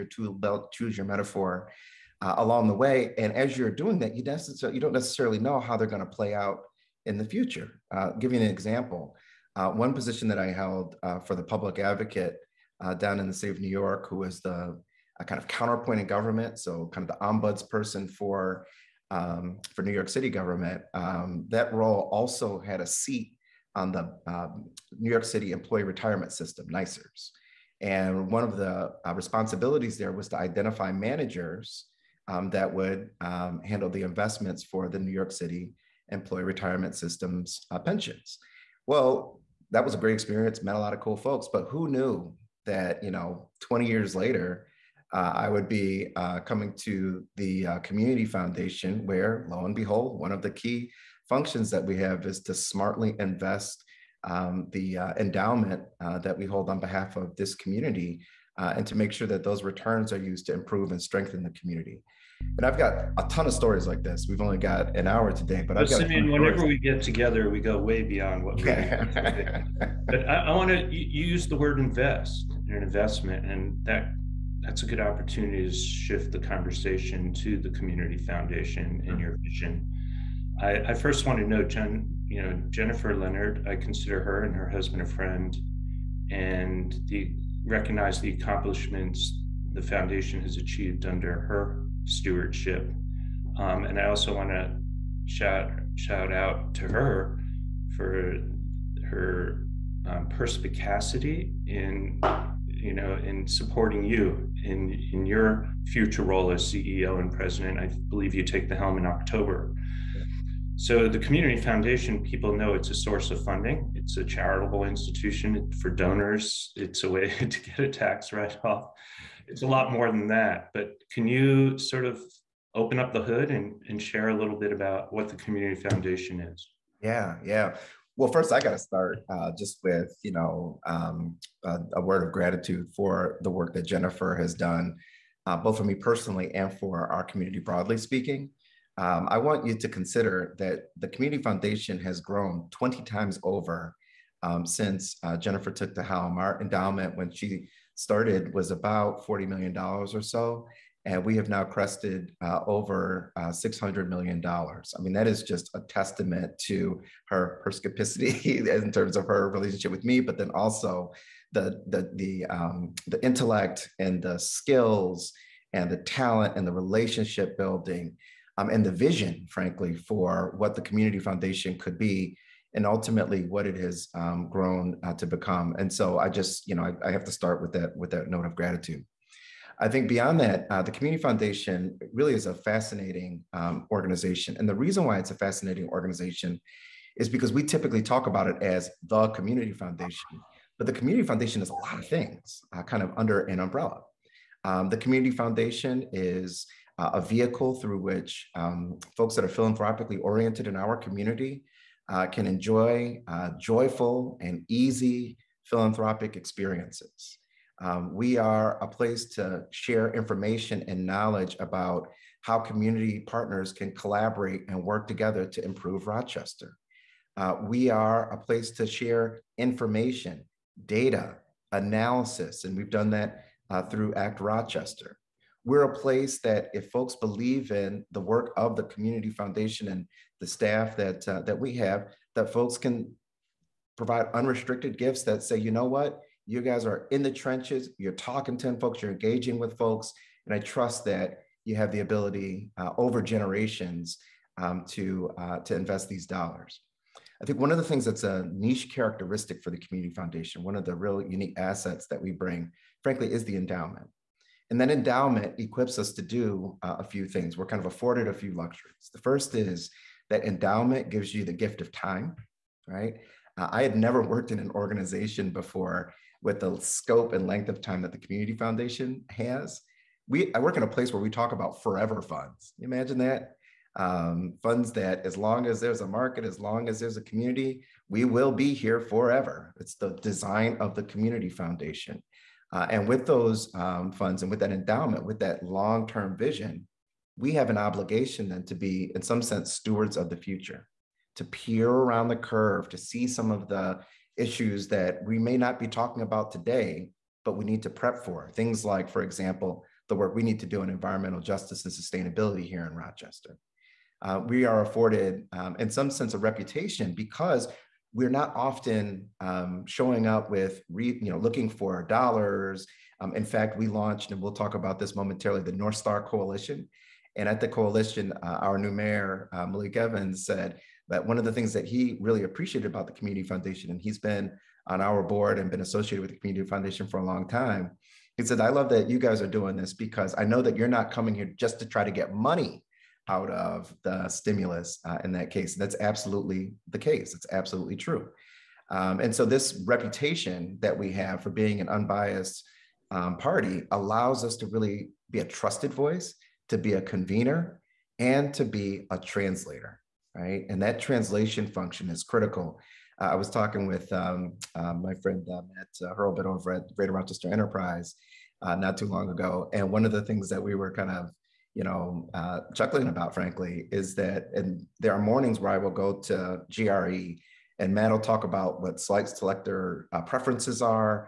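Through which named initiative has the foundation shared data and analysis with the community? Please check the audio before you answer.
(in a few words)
ACT Rochester.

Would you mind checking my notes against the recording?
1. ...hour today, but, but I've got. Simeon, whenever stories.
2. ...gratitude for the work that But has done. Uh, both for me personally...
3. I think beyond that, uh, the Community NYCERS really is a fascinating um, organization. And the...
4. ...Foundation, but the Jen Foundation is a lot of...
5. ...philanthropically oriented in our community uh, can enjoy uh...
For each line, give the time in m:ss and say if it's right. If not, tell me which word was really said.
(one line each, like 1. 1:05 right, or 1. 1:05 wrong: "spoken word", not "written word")
1. 1:05 right
2. 2:12 wrong: "Jennifer", not "But"
3. 2:59 wrong: "Foundation", not "NYCERS"
4. 3:09 wrong: "Community", not "Jen"
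5. 3:19 right.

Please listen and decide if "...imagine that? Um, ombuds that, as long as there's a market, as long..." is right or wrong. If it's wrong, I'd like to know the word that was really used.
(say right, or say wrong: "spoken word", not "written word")
wrong: "funds", not "ombuds".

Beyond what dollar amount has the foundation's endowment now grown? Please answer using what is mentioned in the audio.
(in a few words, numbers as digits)
$600 million.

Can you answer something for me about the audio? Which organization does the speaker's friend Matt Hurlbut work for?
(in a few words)
Greater Rochester Enterprise.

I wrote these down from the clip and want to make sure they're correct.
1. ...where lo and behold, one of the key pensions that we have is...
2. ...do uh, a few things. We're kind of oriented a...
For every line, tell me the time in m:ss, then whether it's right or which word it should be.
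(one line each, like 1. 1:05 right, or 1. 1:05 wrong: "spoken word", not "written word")
1. 0:49 wrong: "functions", not "pensions"
2. 4:16 wrong: "afforded", not "oriented".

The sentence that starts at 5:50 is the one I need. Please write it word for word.
And that translation function is critical.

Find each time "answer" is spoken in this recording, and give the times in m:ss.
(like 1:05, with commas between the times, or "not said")
not said.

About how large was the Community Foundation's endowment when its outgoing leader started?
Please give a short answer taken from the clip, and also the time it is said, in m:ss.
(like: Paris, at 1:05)
$40 million, at 2:29.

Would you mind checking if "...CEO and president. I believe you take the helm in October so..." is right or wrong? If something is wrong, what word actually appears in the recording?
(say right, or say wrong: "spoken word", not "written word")
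right.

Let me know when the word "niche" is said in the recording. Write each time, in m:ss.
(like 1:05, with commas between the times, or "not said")
4:08.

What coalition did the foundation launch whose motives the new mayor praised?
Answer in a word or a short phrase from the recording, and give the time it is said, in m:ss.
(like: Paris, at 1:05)
North Star Coalition, at 5:15.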